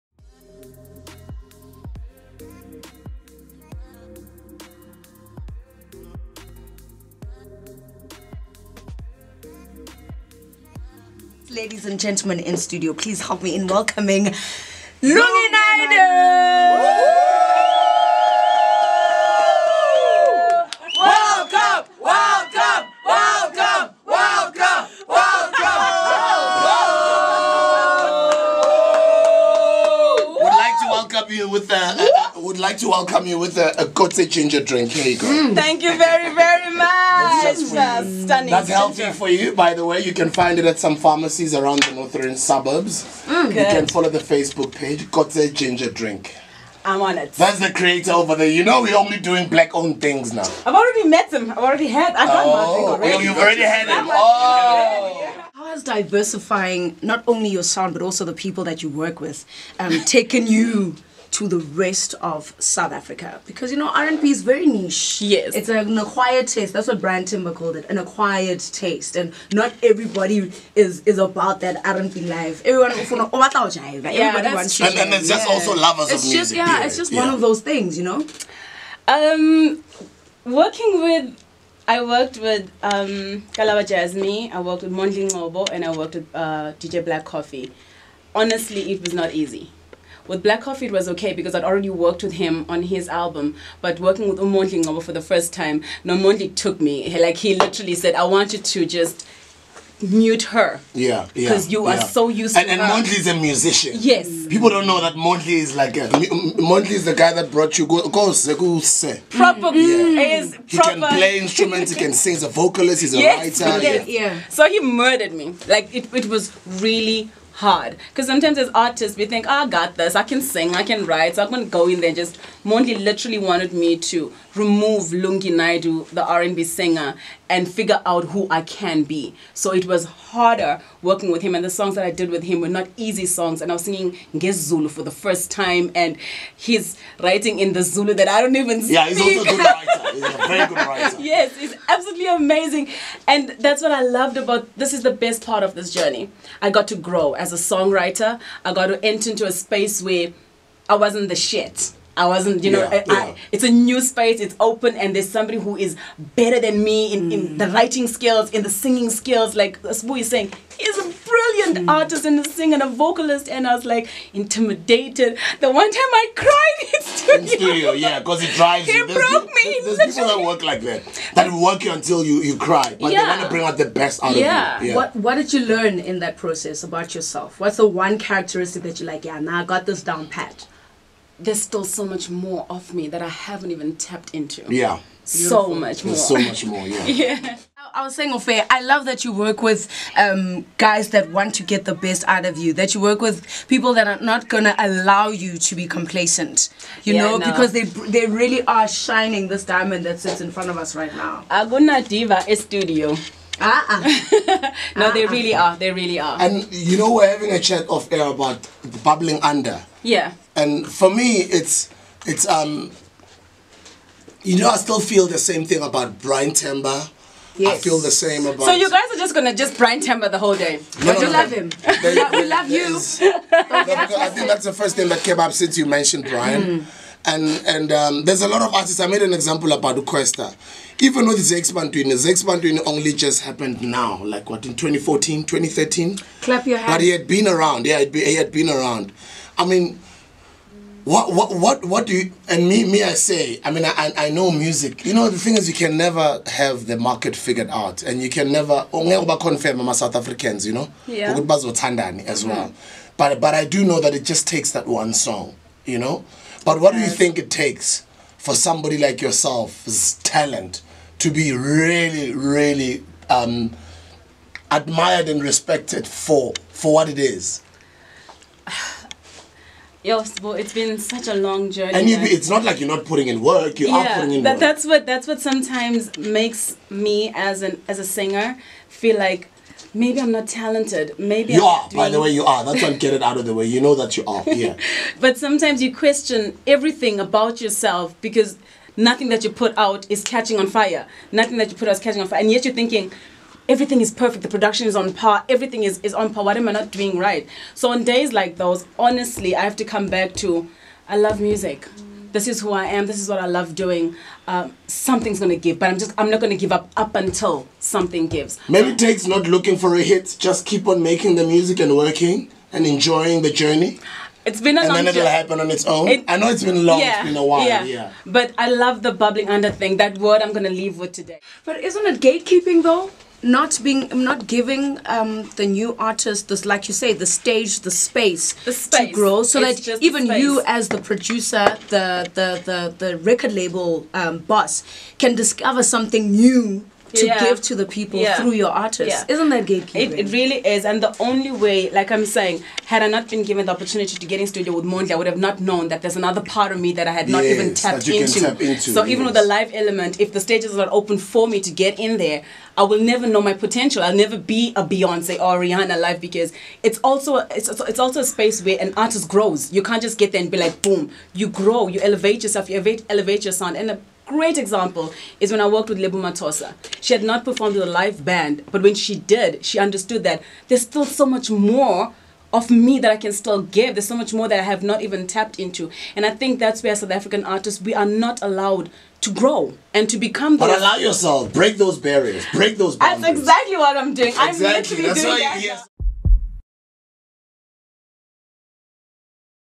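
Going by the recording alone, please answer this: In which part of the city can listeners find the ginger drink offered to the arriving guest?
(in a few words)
Northern suburbs.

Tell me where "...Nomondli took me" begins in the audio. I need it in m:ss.
1:36.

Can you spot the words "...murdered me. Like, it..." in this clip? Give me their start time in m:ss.
1:54.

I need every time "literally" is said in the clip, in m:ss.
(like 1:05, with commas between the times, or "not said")
1:37, 2:03, 6:24.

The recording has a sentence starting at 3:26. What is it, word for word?
And you know, we're having a chat off air about bubbling under.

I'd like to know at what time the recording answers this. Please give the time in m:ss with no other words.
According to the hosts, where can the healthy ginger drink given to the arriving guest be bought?
0:40.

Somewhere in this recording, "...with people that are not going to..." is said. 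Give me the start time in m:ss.
3:13.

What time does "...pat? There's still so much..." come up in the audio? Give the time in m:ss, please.
3:00.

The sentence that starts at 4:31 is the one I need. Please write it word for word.
And you, it's not like you're not putting in work.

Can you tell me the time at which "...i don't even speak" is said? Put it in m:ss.
2:18.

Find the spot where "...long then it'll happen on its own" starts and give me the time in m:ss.
5:14.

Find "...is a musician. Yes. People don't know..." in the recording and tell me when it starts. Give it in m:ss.
1:43.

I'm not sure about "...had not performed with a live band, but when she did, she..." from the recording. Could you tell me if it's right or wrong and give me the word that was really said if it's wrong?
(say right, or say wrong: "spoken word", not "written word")
right.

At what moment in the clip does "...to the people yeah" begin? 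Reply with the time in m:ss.
5:37.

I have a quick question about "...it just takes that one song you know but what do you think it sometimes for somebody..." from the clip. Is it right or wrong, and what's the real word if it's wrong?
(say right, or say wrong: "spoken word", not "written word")
wrong: "takes", not "sometimes".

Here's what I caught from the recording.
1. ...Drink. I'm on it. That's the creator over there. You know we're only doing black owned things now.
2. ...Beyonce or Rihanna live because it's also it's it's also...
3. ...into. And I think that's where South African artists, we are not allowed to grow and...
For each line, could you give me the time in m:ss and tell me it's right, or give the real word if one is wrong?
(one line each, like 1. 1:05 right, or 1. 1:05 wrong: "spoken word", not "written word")
1. 0:45 right
2. 5:54 right
3. 6:15 right.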